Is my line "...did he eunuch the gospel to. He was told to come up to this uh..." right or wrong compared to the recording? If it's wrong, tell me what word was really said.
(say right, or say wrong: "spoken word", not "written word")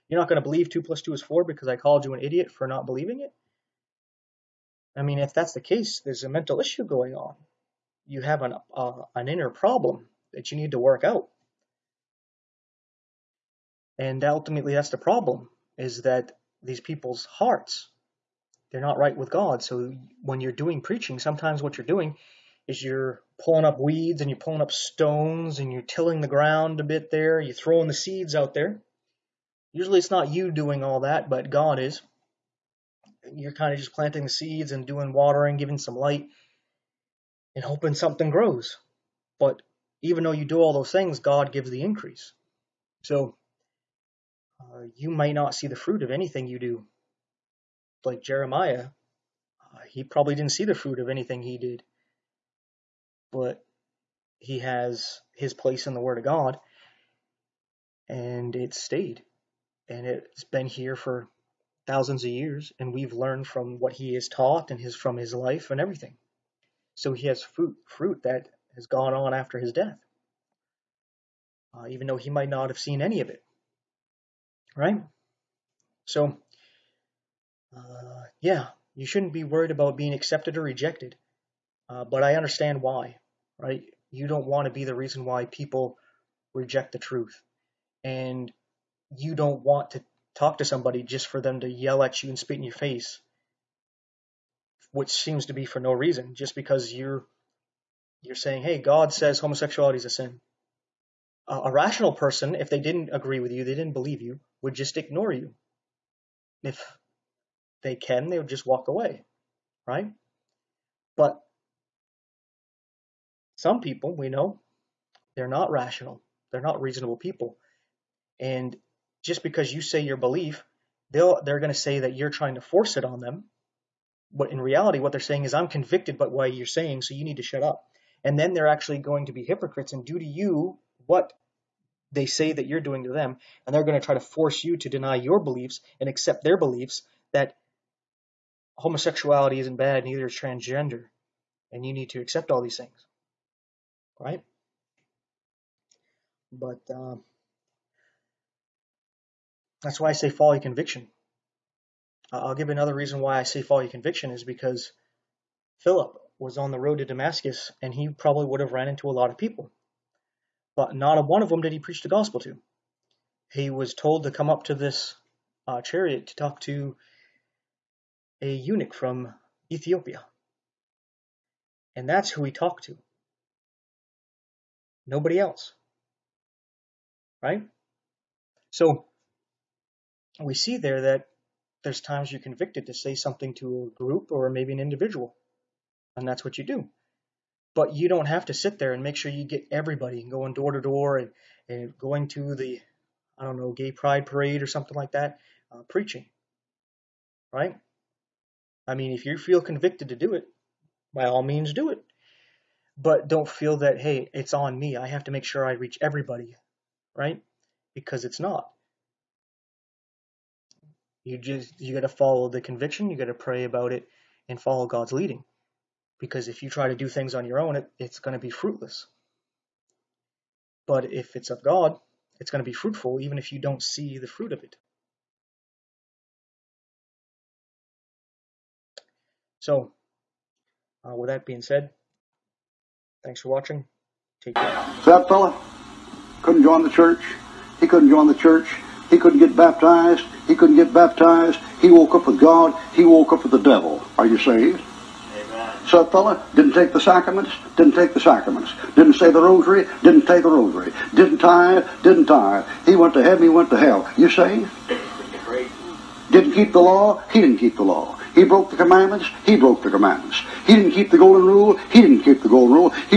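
wrong: "preach", not "eunuch".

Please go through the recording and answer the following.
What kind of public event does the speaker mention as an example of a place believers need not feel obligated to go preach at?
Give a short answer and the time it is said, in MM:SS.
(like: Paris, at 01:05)
gay pride parade, at 03:13.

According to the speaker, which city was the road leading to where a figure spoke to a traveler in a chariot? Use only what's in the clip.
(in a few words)
Damascus.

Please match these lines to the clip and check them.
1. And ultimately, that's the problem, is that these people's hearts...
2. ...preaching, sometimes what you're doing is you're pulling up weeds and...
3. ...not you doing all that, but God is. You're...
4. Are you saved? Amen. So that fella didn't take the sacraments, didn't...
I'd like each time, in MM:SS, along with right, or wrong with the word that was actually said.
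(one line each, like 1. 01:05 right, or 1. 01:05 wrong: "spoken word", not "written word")
1. 00:13 right
2. 00:20 right
3. 00:30 right
4. 04:04 right.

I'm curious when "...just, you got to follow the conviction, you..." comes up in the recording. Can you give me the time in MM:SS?
03:31.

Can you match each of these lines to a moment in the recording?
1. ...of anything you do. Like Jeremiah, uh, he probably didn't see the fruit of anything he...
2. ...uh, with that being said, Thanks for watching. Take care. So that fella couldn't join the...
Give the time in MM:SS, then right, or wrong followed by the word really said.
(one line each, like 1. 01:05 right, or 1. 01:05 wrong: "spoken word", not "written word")
1. 00:46 right
2. 03:51 right.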